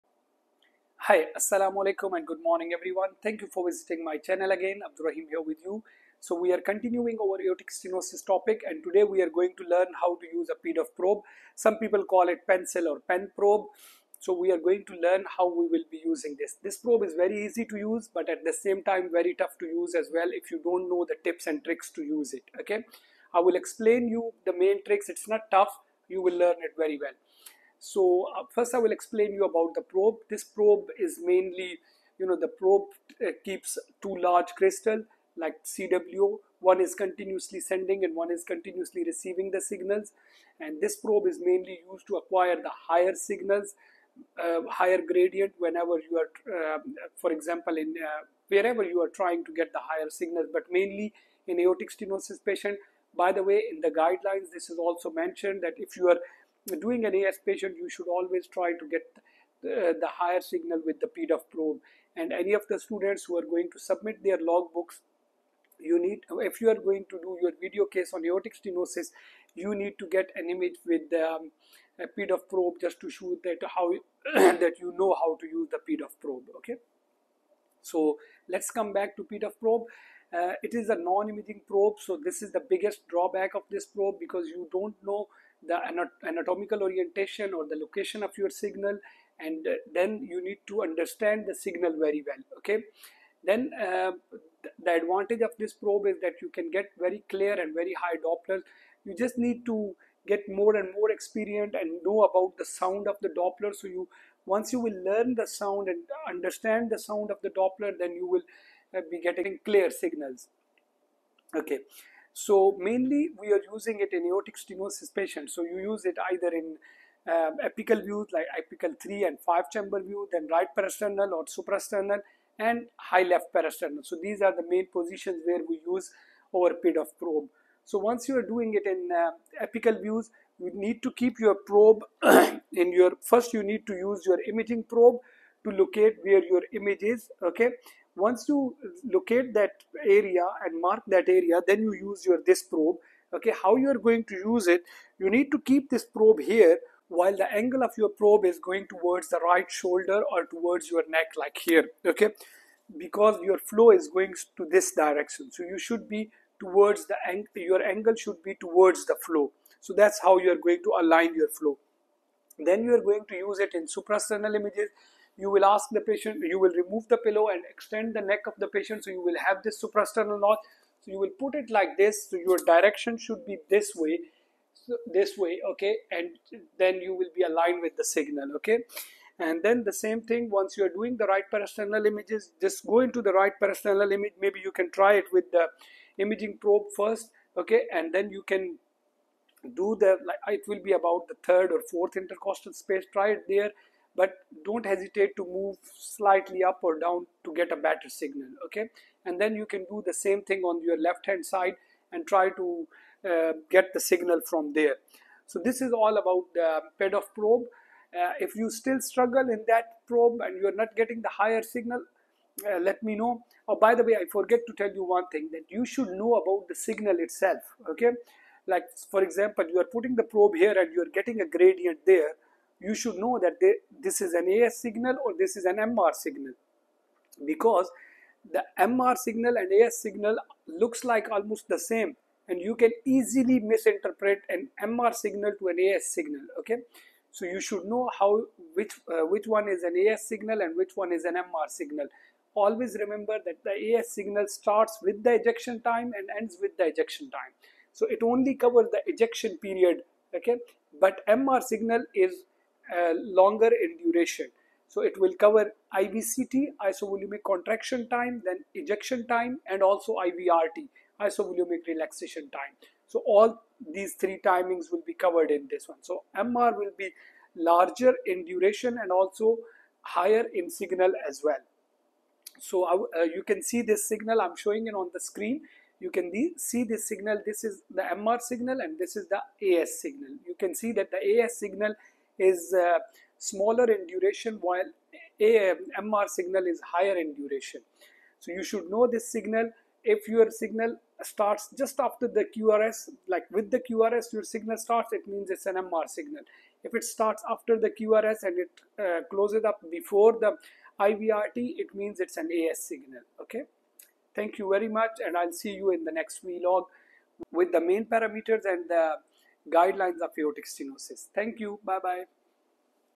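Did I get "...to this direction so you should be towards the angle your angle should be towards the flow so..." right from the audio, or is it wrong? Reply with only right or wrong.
right.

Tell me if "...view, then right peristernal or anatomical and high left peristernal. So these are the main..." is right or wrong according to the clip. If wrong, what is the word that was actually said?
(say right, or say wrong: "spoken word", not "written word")
wrong: "suprasternal", not "anatomical".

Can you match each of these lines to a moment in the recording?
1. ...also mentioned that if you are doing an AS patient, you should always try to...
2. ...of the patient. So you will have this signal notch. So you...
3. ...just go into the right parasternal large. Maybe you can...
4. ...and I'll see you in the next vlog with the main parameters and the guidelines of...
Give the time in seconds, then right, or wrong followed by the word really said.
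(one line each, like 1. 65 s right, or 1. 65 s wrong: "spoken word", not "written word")
1. 54 s right
2. 168 s wrong: "suprasternal", not "signal"
3. 182 s wrong: "image", not "large"
4. 305 s right.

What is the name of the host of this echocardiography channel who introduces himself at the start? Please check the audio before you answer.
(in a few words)
Abdurrahim.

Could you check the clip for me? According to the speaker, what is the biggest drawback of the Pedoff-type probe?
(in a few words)
non-imaging probe.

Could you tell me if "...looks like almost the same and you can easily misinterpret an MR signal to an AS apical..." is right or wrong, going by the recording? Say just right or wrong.
wrong.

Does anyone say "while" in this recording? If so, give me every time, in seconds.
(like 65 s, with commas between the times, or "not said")
147 s, 284 s.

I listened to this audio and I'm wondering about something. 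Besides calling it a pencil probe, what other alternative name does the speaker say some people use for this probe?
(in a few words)
pen probe.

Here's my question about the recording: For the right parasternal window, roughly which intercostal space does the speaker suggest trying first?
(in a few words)
third or fourth.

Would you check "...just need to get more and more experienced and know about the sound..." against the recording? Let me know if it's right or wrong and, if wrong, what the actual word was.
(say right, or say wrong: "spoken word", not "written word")
right.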